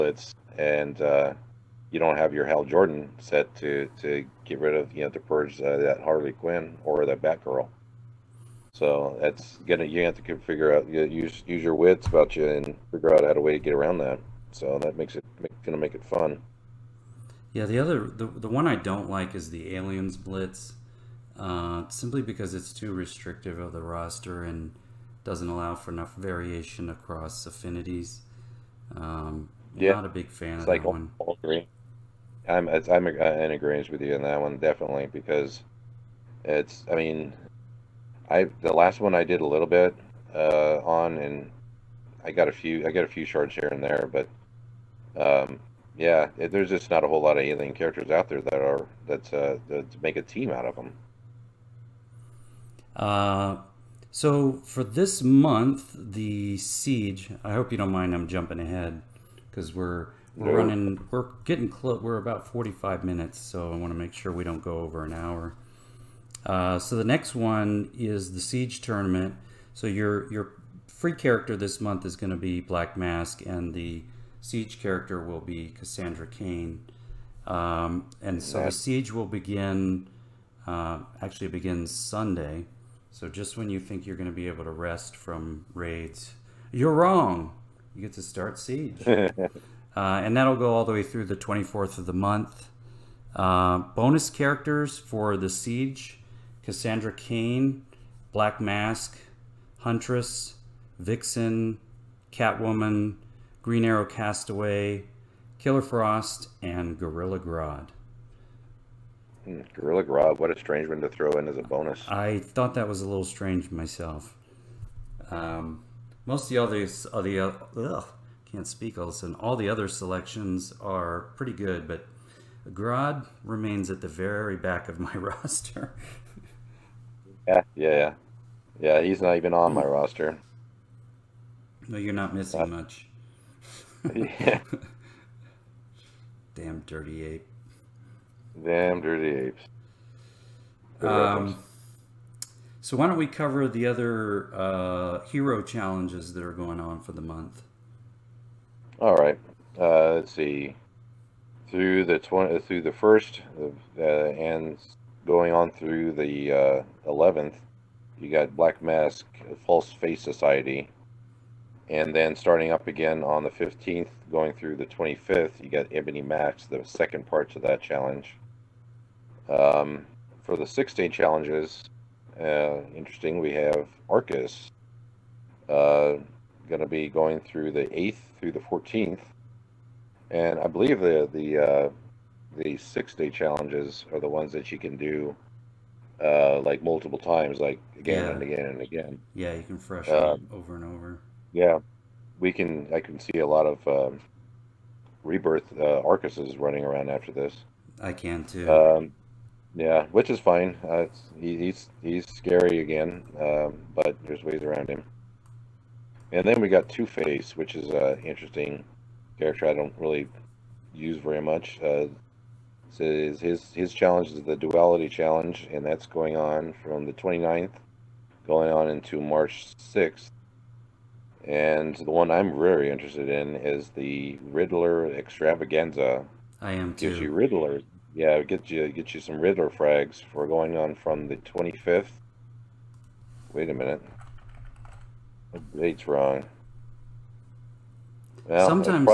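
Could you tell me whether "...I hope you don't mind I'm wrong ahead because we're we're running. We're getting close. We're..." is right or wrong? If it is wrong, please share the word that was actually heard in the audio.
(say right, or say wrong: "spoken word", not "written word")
wrong: "jumping", not "wrong".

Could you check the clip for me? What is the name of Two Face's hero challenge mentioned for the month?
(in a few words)
Duality challenge.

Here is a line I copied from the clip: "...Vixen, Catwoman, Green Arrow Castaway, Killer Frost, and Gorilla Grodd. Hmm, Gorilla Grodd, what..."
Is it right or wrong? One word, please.
right.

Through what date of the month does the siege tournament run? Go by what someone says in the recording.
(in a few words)
24th.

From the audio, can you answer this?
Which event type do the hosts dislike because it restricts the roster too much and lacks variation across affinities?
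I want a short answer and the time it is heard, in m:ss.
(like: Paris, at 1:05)
Aliens blitz, at 0:19.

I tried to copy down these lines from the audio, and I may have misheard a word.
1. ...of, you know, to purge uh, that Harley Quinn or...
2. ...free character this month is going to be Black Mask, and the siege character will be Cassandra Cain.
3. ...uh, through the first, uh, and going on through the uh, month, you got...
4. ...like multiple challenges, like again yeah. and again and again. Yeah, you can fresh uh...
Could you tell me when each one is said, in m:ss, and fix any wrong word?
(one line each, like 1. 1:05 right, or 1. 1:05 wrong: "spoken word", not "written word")
1. 0:04 right
2. 1:10 right
3. 2:32 wrong: "eleventh", not "month"
4. 3:06 wrong: "times", not "challenges".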